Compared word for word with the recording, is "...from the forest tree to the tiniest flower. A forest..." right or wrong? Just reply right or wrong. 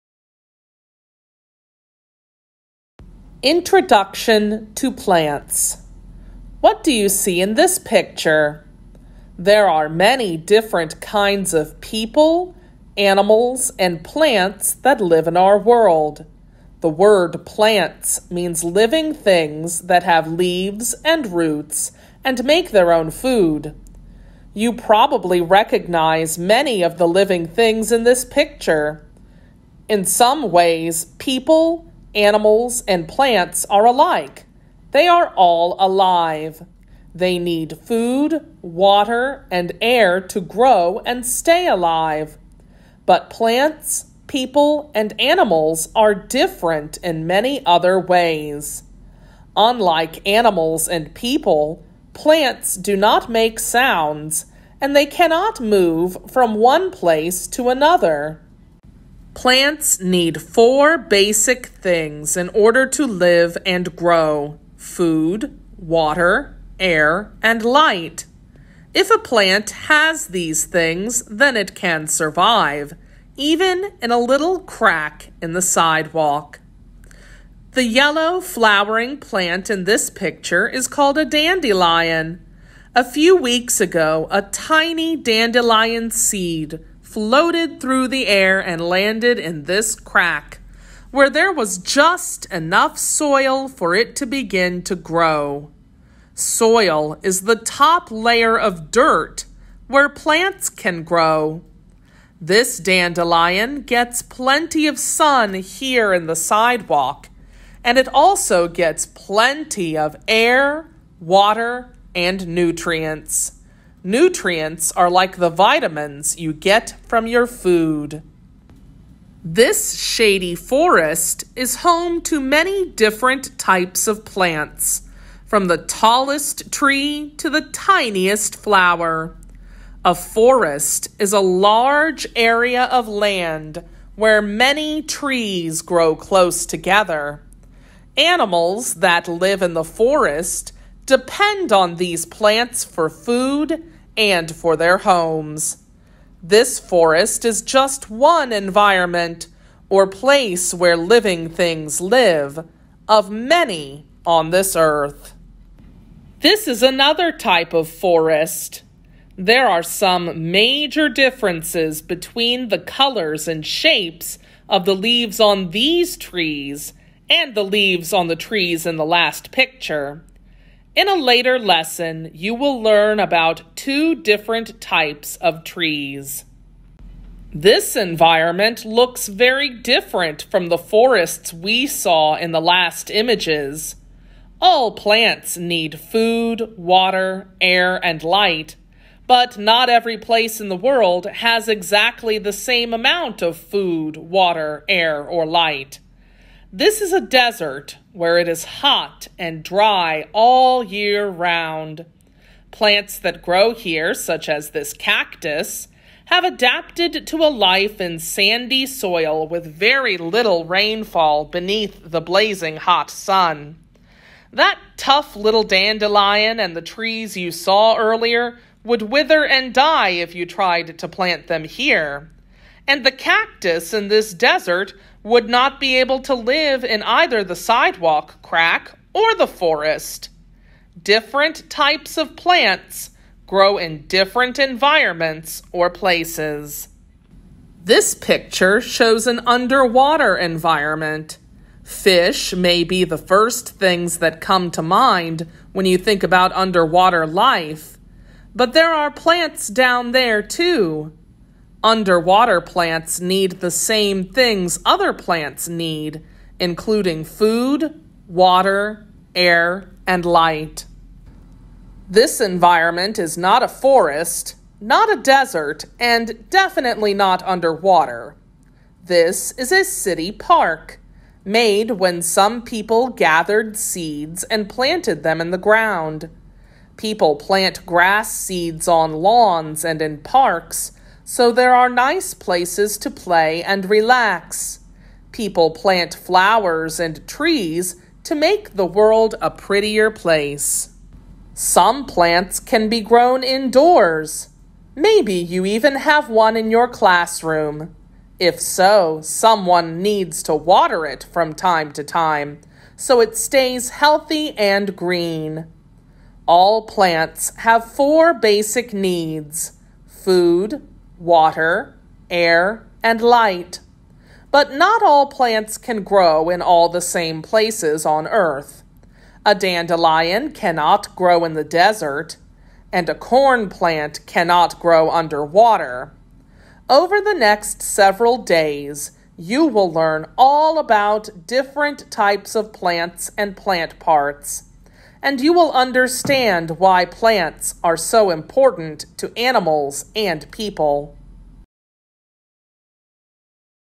wrong.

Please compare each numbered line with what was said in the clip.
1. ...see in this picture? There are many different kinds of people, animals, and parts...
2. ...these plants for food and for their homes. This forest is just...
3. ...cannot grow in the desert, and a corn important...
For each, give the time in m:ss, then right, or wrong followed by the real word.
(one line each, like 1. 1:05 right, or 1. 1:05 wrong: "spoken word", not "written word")
1. 0:07 wrong: "plants", not "parts"
2. 2:21 right
3. 5:20 wrong: "plant", not "important".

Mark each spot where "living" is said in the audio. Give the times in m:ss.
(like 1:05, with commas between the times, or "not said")
0:18, 0:27, 2:30.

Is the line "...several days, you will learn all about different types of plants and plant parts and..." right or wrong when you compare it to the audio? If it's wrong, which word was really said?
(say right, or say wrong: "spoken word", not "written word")
right.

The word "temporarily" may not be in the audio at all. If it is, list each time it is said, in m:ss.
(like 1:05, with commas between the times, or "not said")
not said.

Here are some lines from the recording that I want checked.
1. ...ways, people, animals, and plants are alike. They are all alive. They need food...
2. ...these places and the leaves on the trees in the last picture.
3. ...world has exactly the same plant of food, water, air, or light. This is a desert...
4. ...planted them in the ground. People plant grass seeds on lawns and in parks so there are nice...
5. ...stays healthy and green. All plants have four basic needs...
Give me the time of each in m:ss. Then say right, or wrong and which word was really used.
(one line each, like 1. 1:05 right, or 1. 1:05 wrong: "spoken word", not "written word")
1. 0:30 right
2. 2:45 wrong: "trees", not "places"
3. 3:10 wrong: "amount", not "plant"
4. 4:34 right
5. 5:03 right.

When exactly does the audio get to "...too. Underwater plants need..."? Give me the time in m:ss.
4:10.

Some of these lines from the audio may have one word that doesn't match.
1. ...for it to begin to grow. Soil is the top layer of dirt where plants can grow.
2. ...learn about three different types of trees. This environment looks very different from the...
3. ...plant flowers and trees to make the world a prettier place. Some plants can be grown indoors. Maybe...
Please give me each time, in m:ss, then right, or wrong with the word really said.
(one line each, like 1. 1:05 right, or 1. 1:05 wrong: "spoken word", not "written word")
1. 1:33 right
2. 2:52 wrong: "two", not "three"
3. 4:45 right.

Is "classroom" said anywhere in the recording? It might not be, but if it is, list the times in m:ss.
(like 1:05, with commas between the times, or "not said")
4:56.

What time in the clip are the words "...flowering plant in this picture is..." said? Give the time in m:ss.
1:18.